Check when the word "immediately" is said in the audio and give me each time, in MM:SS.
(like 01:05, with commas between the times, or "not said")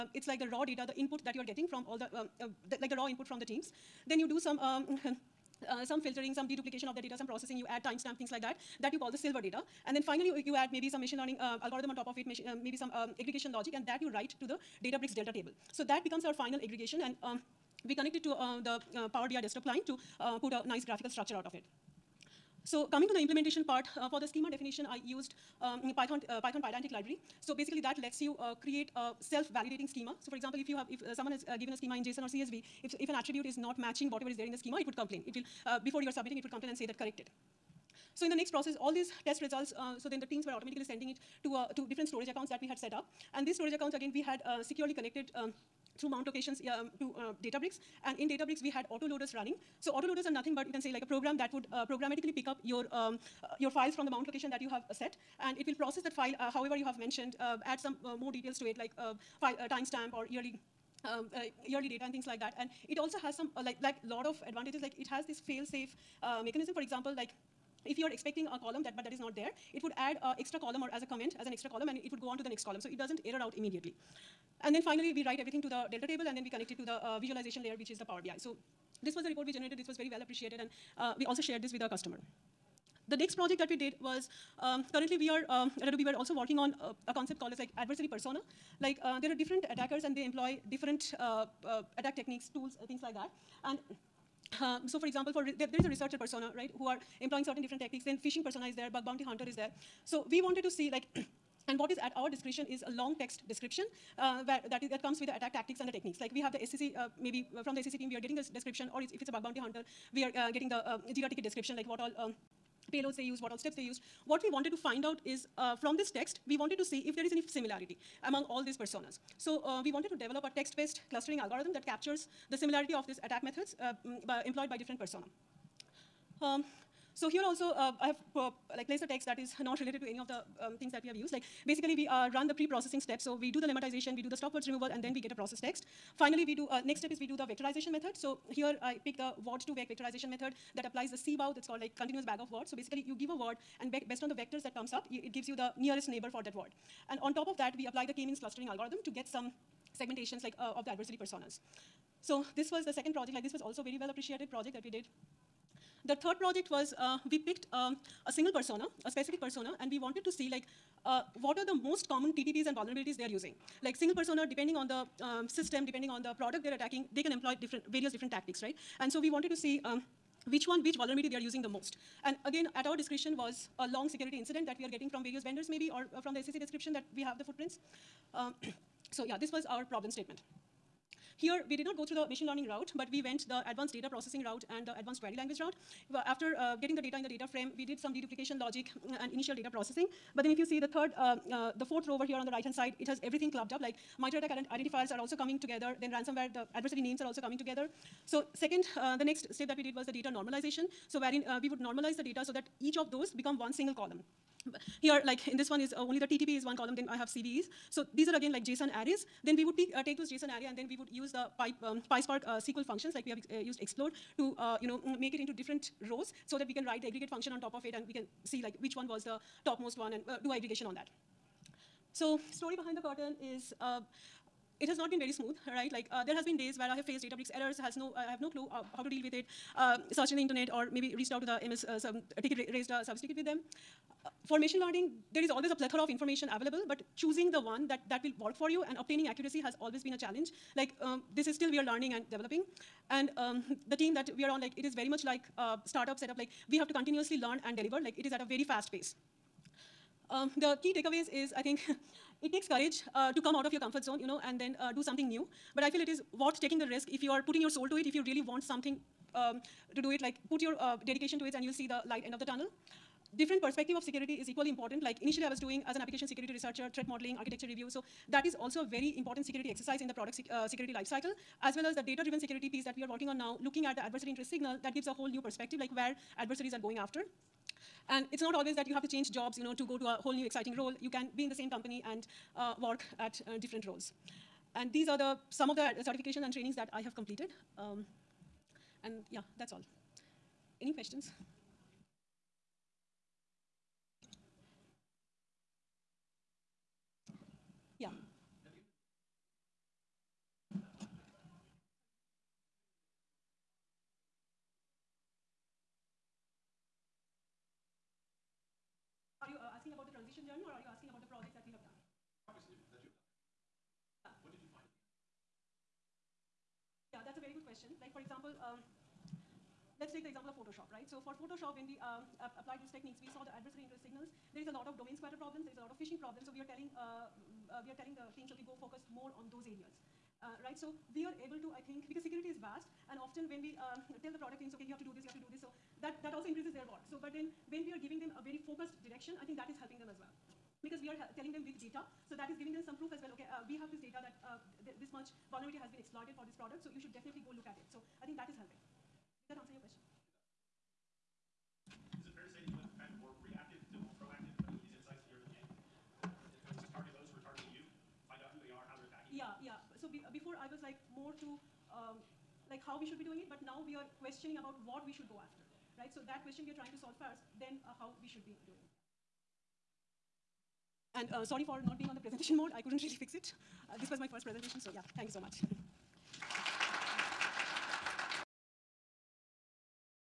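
01:13.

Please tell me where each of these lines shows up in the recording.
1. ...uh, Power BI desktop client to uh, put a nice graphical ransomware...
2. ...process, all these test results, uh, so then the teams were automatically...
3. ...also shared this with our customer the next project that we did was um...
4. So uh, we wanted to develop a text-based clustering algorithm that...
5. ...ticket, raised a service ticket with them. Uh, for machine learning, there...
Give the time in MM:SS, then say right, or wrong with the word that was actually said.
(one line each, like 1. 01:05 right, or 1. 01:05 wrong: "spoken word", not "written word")
1. 00:18 wrong: "structure", not "ransomware"
2. 00:38 right
3. 01:21 right
4. 01:59 right
5. 03:52 right.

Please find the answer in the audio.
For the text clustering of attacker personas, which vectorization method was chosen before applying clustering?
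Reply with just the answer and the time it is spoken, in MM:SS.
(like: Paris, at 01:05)
Word2Vec, at 02:19.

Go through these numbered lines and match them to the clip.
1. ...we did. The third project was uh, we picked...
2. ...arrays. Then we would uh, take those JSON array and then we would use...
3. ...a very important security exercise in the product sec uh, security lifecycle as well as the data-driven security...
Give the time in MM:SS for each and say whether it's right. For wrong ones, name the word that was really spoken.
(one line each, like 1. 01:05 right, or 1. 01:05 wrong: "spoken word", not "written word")
1. 02:34 right
2. 03:28 right
3. 04:28 right.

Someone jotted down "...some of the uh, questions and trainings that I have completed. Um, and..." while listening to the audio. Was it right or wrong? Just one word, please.
wrong.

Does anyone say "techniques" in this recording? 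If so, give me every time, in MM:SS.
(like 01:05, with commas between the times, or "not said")
01:32, 01:45, 05:22.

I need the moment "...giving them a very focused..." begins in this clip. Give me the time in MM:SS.
05:38.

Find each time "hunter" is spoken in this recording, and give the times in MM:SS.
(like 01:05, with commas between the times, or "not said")
01:39, 01:49.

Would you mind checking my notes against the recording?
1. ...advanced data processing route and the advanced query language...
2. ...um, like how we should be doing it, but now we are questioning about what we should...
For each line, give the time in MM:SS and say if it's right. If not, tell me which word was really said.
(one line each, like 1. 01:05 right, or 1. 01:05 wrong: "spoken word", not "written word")
1. 03:03 right
2. 06:01 right.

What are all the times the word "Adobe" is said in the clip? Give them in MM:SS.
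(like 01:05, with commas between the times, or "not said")
01:25.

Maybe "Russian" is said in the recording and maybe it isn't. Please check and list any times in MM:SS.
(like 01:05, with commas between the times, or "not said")
not said.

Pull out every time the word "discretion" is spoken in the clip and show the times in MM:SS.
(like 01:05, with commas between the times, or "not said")
01:42, 02:52.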